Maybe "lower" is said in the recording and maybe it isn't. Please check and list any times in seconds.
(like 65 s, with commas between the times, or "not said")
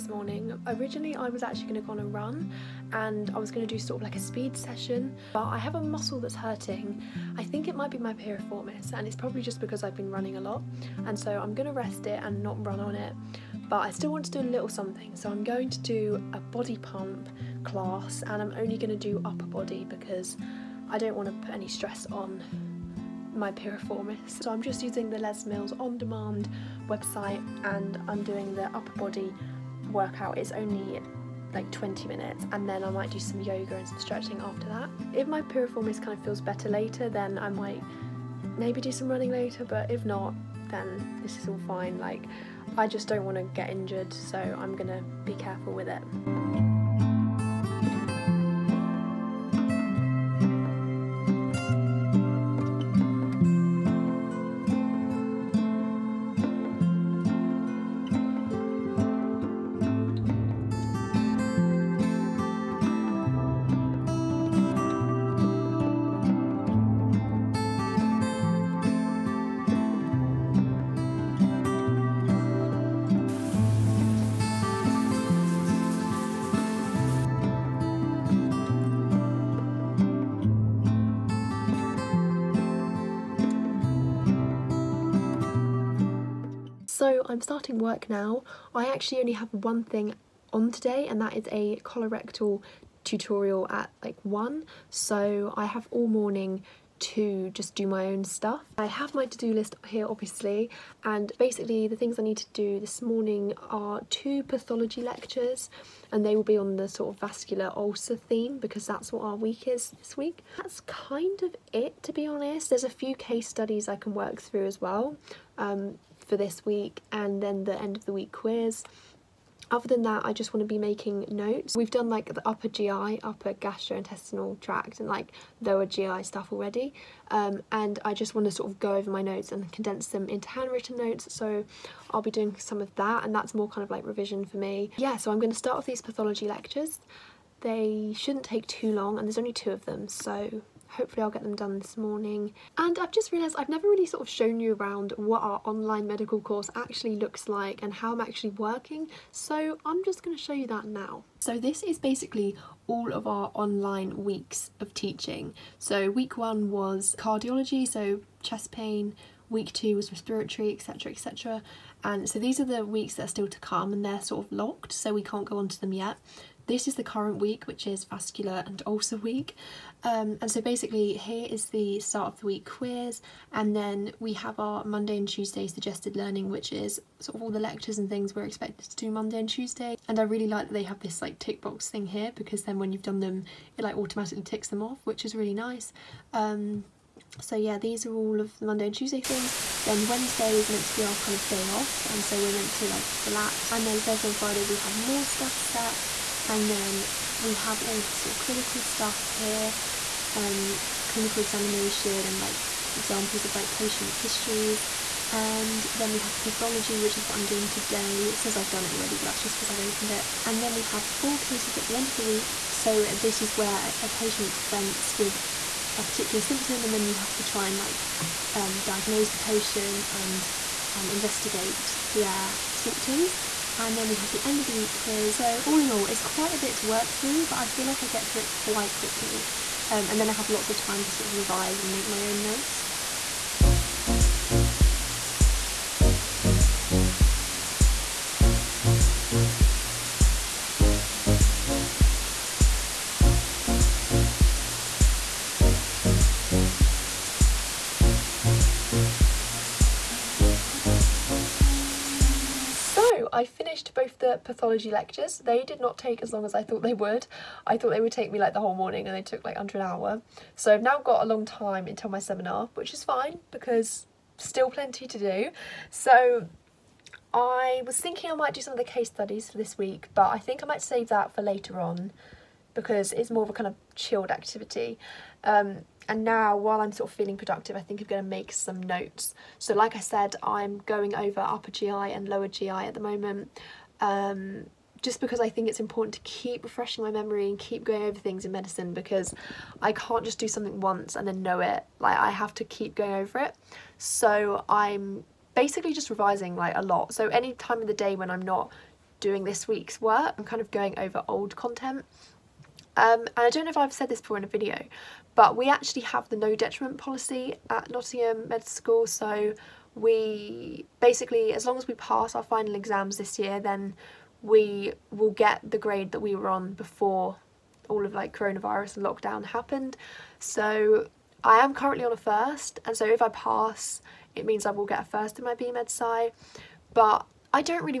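125 s, 282 s.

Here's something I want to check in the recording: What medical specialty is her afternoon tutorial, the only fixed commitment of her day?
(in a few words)
Colorectal.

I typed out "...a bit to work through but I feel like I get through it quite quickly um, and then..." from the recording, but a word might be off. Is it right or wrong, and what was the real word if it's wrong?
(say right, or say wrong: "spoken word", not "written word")
right.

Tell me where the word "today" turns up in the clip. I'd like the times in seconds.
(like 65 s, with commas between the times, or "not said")
90 s, 207 s.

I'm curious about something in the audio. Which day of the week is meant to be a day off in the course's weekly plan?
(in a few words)
Wednesday.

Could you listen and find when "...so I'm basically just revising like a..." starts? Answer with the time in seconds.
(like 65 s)
293 s.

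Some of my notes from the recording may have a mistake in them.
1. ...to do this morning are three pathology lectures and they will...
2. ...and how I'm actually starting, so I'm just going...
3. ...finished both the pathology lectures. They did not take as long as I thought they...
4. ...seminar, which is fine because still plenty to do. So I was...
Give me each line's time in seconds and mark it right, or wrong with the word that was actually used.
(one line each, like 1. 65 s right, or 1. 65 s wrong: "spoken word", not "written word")
1. 102 s wrong: "two", not "three"
2. 147 s wrong: "working", not "starting"
3. 253 s right
4. 262 s right.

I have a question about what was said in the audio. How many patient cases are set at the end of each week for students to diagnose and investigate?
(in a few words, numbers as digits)
4.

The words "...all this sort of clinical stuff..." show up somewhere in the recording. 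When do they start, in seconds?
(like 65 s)
197 s.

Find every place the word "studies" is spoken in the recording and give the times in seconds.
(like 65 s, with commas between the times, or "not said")
113 s, 269 s.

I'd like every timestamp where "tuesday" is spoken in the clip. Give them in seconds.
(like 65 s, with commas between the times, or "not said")
175 s, 179 s, 188 s.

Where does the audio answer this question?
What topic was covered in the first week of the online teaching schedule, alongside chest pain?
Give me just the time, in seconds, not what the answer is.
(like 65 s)
157 s.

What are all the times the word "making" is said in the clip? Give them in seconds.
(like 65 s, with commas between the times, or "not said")
120 s.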